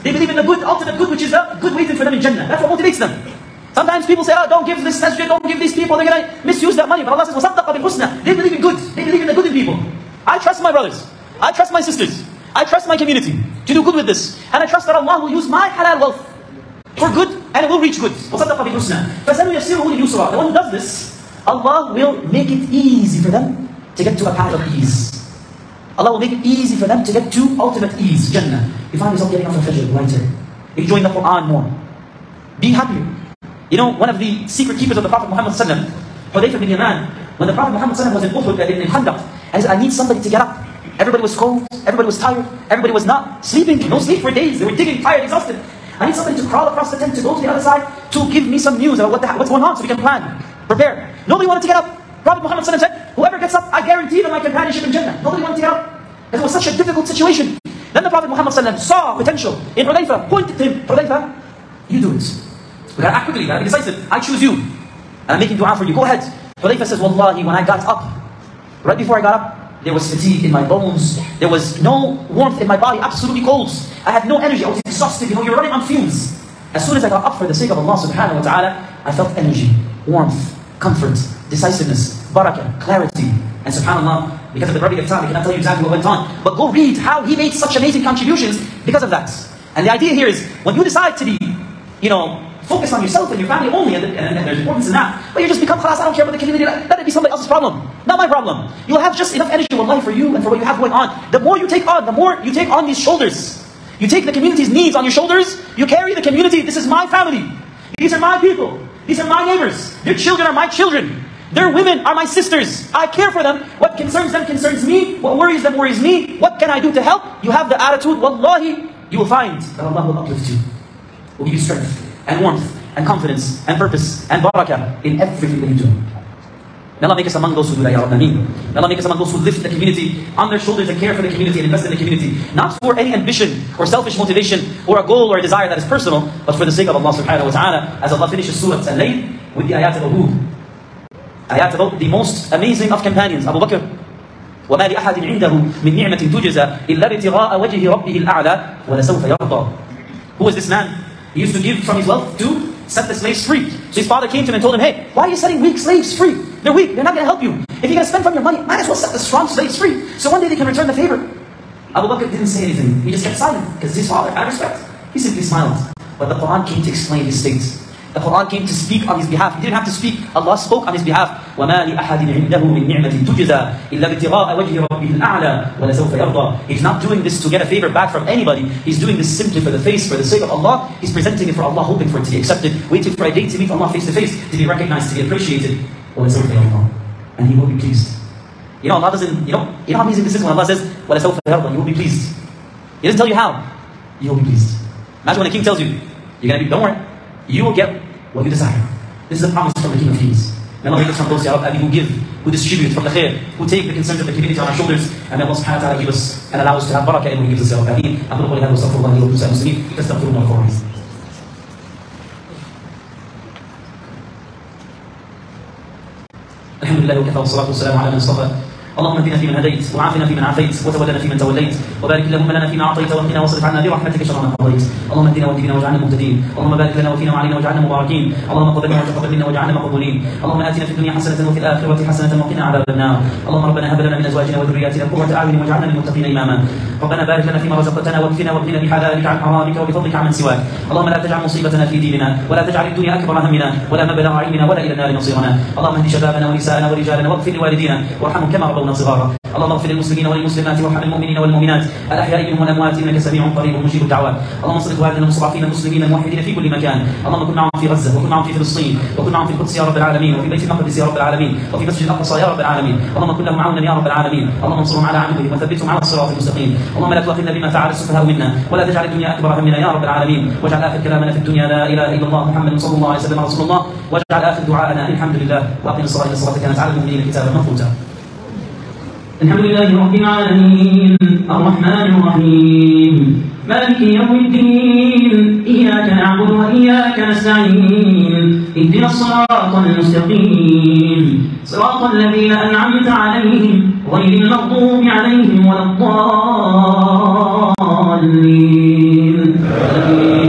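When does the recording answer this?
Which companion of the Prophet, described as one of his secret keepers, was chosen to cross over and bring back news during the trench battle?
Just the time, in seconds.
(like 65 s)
35 s.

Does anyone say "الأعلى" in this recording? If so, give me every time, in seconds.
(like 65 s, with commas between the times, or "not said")
148 s, 175 s.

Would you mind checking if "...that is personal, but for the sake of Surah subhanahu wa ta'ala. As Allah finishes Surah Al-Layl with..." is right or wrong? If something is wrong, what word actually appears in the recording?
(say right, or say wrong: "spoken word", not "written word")
wrong: "Allah", not "Surah".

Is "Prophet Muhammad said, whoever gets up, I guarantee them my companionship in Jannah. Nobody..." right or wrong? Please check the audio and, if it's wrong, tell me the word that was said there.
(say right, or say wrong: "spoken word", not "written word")
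right.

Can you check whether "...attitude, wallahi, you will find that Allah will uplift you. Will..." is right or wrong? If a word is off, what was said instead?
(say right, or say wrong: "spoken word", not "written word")
right.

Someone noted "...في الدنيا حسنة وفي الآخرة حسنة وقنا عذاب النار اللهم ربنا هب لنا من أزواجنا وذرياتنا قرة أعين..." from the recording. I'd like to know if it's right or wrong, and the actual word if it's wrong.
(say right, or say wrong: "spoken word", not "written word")
right.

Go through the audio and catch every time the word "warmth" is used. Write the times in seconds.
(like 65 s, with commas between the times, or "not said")
72 s, 80 s, 122 s.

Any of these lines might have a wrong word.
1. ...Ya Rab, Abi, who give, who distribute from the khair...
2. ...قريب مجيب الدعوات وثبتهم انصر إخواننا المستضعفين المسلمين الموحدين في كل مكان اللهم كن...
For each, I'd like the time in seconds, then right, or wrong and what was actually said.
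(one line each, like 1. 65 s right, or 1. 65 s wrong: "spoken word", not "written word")
1. 201 s right
2. 253 s wrong: "اللهم", not "وثبتهم".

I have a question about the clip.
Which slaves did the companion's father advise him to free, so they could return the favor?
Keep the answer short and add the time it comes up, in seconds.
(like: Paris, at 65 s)
The strong slaves, at 159 s.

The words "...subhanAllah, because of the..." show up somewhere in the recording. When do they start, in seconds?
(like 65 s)
83 s.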